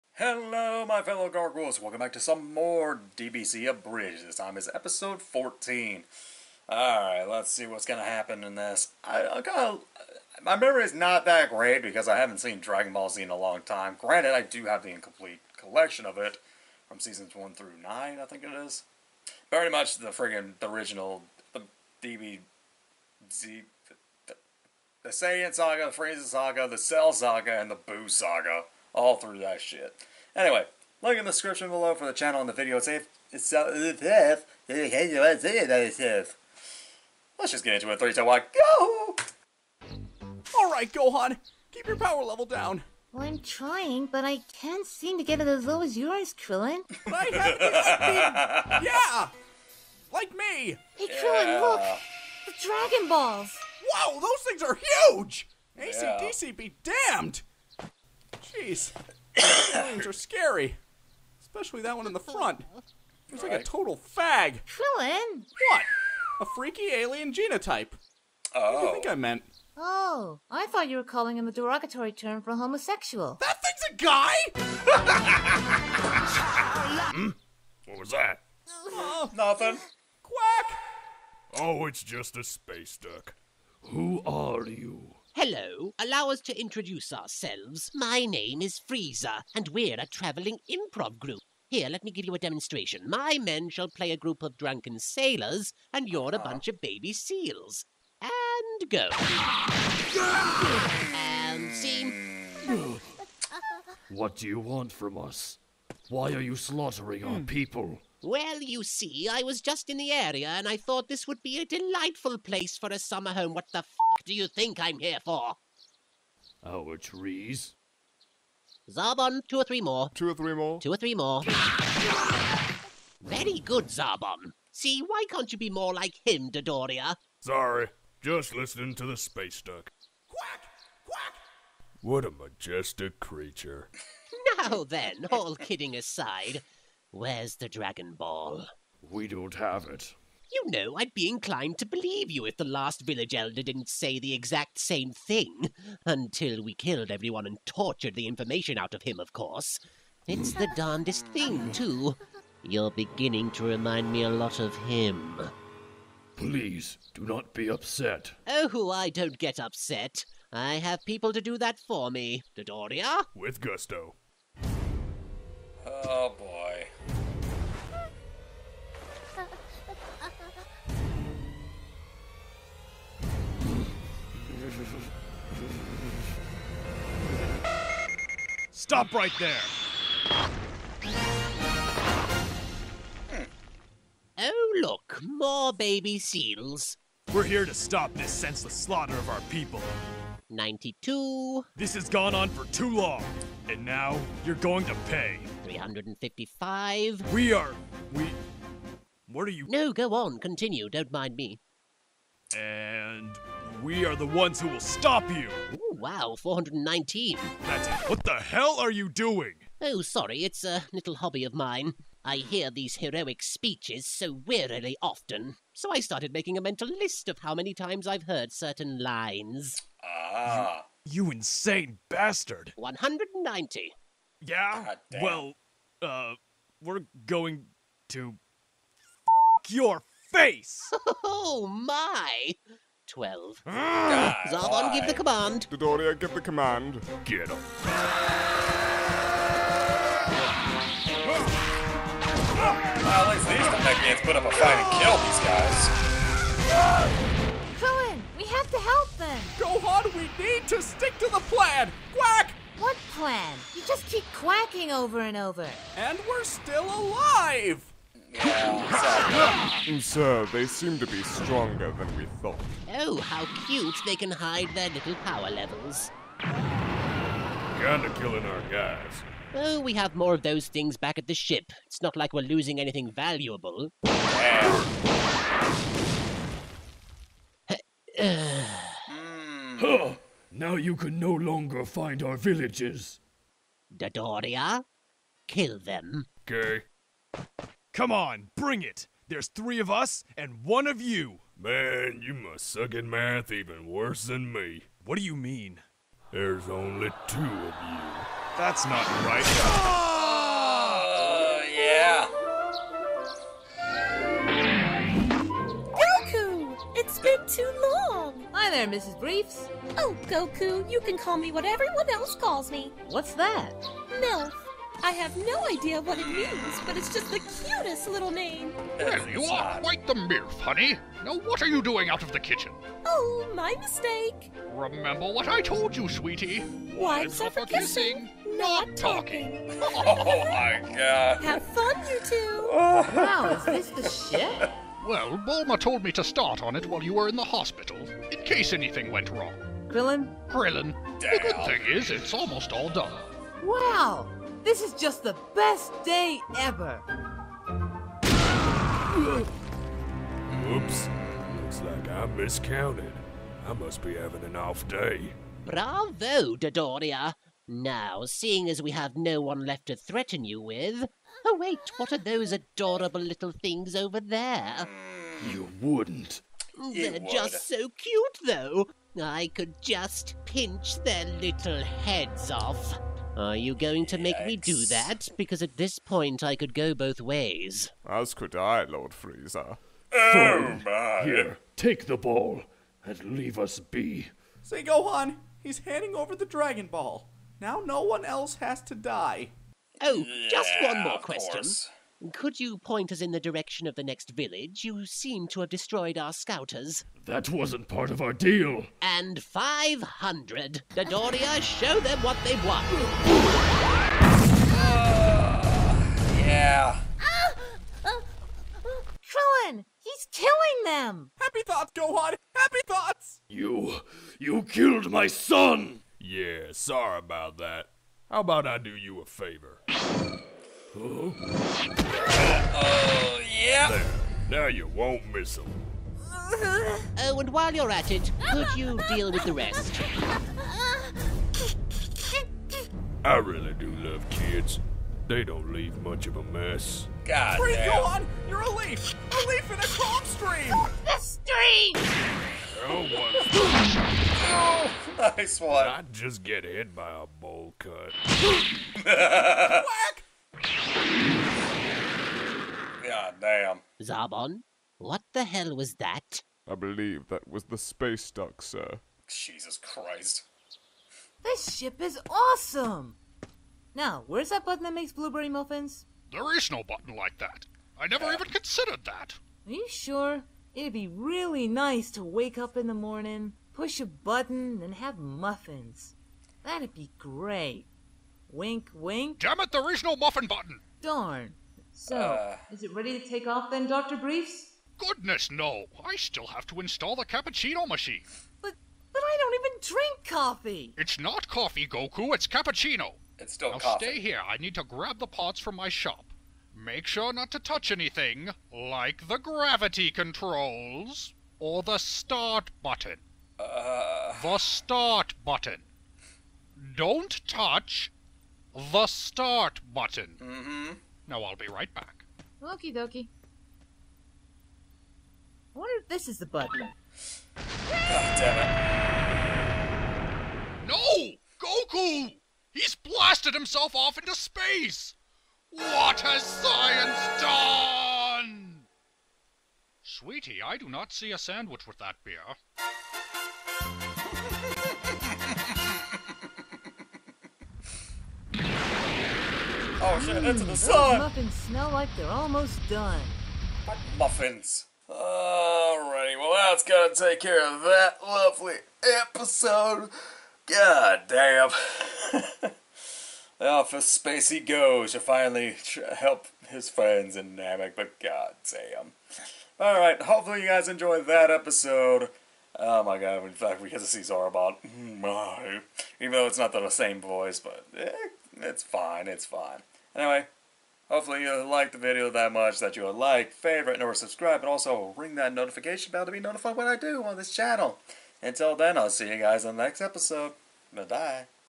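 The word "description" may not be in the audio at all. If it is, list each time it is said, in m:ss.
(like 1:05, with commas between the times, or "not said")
0:31.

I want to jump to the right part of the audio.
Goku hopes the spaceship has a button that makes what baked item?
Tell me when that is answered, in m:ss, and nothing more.
7:45.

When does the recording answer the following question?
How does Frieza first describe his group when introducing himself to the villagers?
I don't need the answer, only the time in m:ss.
1:30.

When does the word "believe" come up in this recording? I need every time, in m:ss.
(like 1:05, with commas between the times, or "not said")
2:21, 7:36.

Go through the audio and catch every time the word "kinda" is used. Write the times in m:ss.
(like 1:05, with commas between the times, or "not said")
0:09, 4:26.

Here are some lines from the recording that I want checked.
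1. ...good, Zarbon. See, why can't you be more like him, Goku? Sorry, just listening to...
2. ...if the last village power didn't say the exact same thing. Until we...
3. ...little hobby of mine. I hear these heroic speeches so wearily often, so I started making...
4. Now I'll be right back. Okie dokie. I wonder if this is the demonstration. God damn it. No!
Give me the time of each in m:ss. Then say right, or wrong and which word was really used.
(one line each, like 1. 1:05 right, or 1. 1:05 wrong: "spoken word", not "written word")
1. 2:03 wrong: "Dodoria", not "Goku"
2. 2:22 wrong: "elder", not "power"
3. 3:30 right
4. 8:31 wrong: "button", not "demonstration".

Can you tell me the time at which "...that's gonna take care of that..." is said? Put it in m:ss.
9:06.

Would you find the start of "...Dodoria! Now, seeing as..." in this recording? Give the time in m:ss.
5:56.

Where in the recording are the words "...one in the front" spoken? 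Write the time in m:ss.
1:01.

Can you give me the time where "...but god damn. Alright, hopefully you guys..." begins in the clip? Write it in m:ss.
9:17.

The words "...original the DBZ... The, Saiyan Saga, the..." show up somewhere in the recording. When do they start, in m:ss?
0:20.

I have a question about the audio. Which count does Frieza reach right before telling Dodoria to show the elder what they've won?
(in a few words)
500.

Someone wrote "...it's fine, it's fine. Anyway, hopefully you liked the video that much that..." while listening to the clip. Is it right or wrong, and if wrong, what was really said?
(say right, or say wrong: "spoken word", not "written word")
right.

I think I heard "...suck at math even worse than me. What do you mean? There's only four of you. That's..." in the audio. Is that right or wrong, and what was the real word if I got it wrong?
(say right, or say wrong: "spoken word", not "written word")
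wrong: "two", not "four".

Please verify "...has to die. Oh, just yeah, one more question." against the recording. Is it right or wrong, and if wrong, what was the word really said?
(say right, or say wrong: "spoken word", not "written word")
right.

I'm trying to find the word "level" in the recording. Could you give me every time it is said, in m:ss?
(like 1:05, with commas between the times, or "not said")
0:42, 4:25.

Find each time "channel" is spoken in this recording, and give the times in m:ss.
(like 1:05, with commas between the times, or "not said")
0:32, 9:37.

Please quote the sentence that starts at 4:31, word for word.
It's not like we're losing anything valuable.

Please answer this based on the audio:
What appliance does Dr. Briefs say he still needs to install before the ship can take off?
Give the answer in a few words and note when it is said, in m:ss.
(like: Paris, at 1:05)
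cappuccino machine, at 8:07.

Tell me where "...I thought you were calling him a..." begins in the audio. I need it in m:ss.
1:10.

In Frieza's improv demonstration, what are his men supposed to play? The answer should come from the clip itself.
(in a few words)
drunken sailors.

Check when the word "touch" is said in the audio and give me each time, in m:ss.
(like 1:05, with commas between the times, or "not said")
8:17, 8:27.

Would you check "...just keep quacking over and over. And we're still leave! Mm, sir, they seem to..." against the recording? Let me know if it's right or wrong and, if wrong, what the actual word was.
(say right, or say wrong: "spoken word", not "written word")
wrong: "alive", not "leave".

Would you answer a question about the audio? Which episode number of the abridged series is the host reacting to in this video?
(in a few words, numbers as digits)
14.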